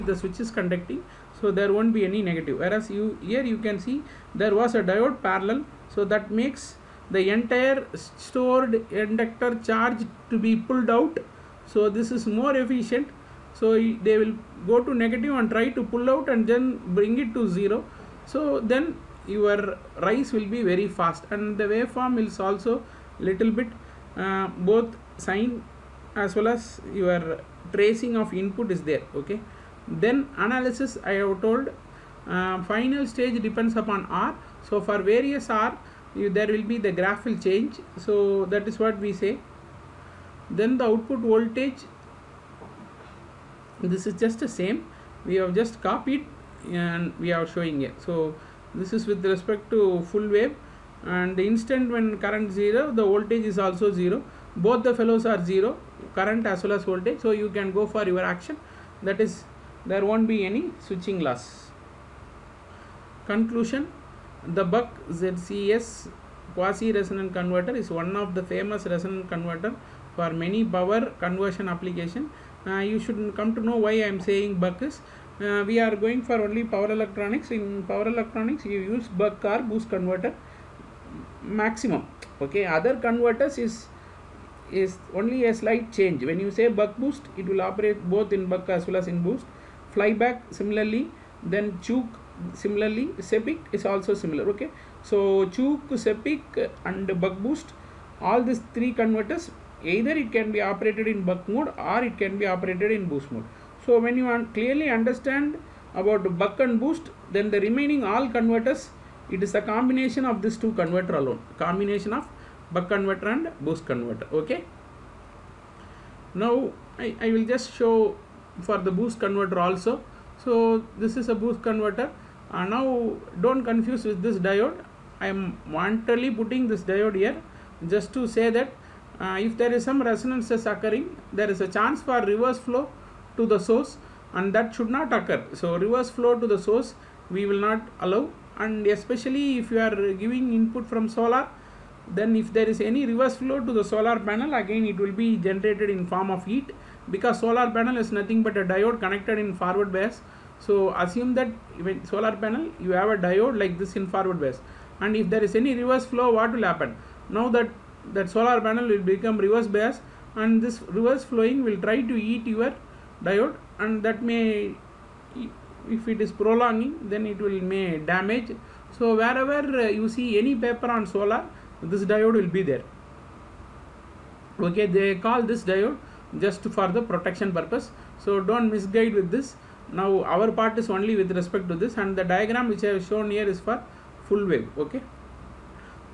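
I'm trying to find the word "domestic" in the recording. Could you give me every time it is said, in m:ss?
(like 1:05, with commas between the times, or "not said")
not said.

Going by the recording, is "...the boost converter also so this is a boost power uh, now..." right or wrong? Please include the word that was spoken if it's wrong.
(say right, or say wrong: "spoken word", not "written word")
wrong: "converter", not "power".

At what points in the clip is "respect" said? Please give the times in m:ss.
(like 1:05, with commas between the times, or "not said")
0:49, 3:01.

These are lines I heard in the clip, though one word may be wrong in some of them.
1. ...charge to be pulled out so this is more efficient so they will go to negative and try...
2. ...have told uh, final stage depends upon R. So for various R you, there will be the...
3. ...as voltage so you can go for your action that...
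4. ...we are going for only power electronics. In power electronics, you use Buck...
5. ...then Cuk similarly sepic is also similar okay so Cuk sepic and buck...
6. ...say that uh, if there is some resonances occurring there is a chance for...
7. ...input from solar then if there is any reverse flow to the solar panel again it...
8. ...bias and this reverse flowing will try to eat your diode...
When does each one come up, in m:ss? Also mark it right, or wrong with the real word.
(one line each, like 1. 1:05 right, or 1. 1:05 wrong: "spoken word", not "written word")
1. 0:09 right
2. 0:31 right
3. 0:56 right
4. 1:15 right
5. 1:31 right
6. 2:08 right
7. 2:20 right
8. 2:39 right.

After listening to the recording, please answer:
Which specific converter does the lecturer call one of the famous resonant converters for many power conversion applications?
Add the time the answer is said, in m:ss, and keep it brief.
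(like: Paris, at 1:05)
Buck ZCS quasi resonant converter, at 1:04.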